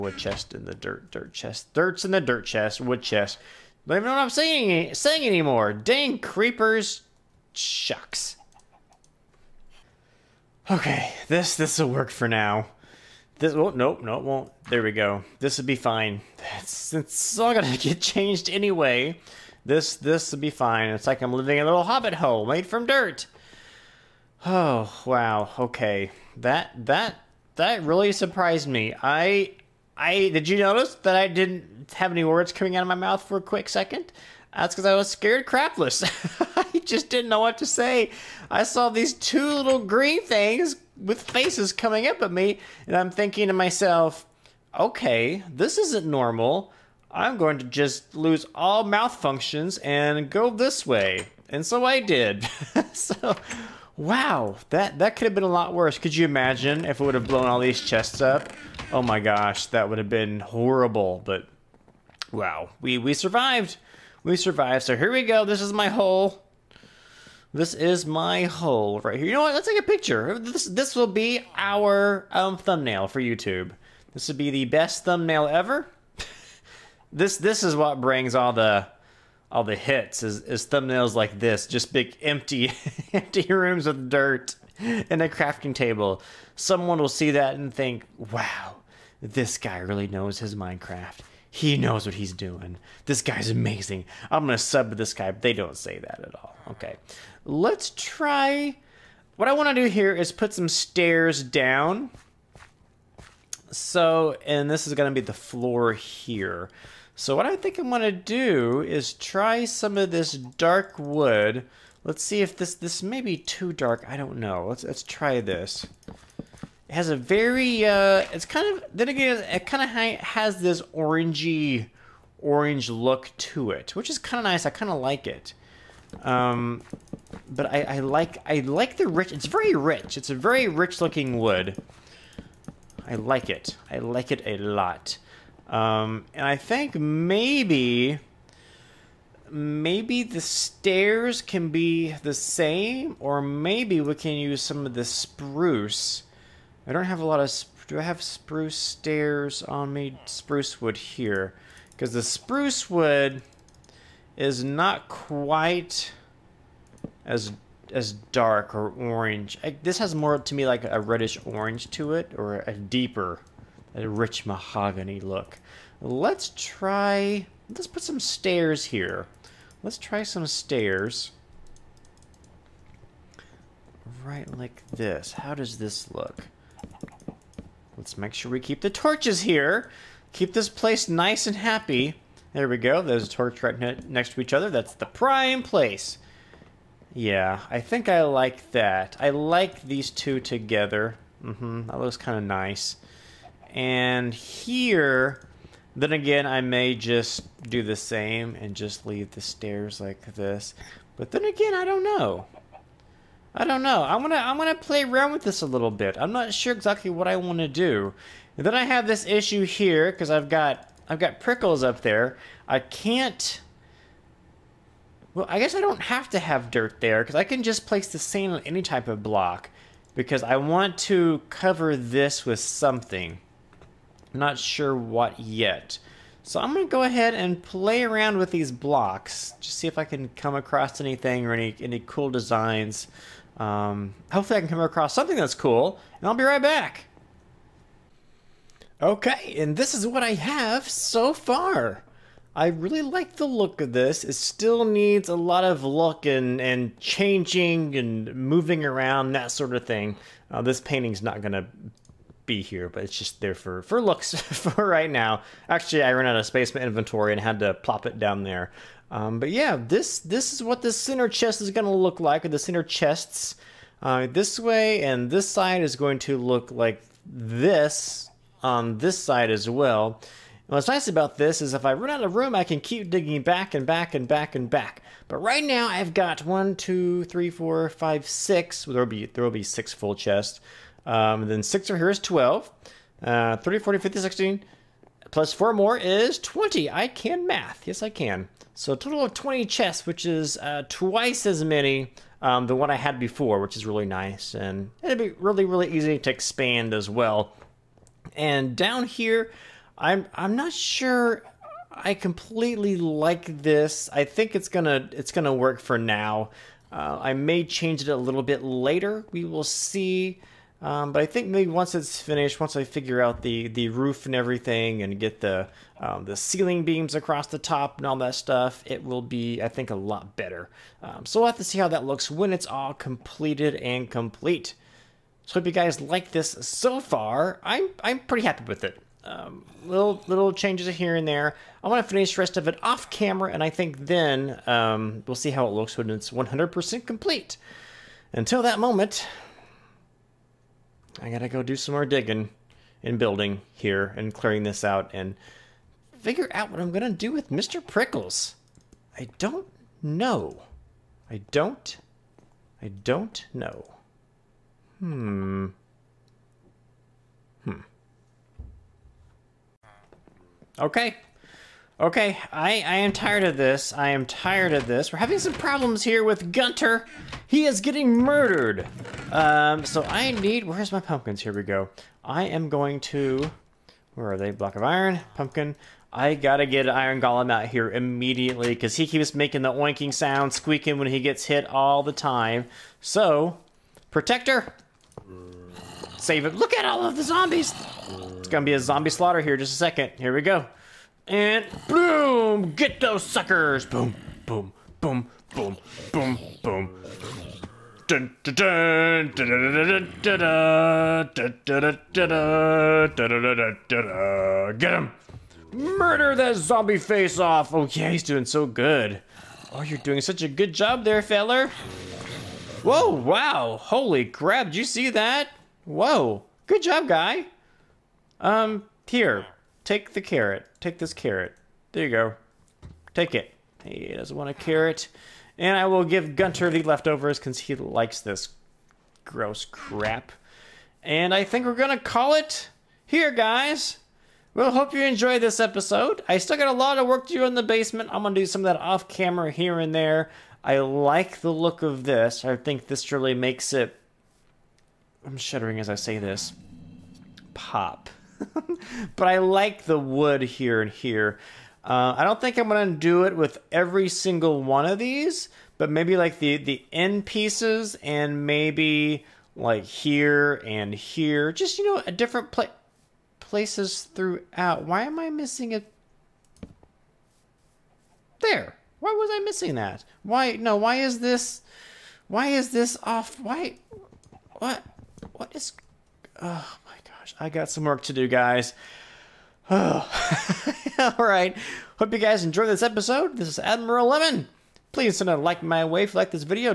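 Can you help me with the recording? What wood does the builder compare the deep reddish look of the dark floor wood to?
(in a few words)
Rich mahogany.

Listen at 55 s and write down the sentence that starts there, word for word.
Could you imagine if it would have blown all these chests up?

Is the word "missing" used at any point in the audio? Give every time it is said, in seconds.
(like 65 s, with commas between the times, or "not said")
465 s, 469 s.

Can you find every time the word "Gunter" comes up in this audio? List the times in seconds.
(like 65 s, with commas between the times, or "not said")
366 s, 426 s.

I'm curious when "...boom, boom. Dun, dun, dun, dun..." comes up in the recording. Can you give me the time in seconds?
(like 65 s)
396 s.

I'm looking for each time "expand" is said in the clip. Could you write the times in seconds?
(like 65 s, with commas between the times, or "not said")
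296 s.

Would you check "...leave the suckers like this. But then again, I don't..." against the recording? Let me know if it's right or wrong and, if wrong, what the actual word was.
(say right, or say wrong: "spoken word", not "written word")
wrong: "stairs", not "suckers".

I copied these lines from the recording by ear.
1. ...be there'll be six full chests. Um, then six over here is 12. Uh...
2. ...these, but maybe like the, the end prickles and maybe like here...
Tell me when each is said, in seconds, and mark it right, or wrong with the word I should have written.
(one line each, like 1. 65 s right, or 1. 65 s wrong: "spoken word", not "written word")
1. 279 s right
2. 454 s wrong: "pieces", not "prickles".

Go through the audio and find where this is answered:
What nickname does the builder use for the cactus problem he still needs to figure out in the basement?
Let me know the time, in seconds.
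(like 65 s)
347 s.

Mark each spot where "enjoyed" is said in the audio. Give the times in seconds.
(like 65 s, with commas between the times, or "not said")
435 s, 482 s.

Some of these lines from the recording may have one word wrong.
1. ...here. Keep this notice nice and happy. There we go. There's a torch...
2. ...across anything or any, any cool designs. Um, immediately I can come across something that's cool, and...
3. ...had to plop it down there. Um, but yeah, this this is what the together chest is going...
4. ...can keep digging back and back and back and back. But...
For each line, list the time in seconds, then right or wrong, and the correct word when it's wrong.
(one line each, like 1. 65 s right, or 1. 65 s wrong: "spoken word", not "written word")
1. 179 s wrong: "place", not "notice"
2. 230 s wrong: "hopefully", not "immediately"
3. 257 s wrong: "center", not "together"
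4. 272 s right.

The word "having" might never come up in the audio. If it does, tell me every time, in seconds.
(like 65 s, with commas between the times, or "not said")
365 s.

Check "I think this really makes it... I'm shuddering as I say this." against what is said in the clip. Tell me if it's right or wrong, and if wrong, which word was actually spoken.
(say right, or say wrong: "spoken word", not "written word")
right.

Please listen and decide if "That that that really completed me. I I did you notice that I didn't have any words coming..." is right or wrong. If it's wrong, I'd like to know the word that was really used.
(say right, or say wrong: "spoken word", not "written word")
wrong: "surprised", not "completed".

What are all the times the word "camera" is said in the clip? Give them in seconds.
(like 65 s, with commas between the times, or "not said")
333 s, 439 s.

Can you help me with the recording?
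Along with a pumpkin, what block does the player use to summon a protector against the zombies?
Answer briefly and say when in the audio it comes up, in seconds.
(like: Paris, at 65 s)
Block of iron, at 374 s.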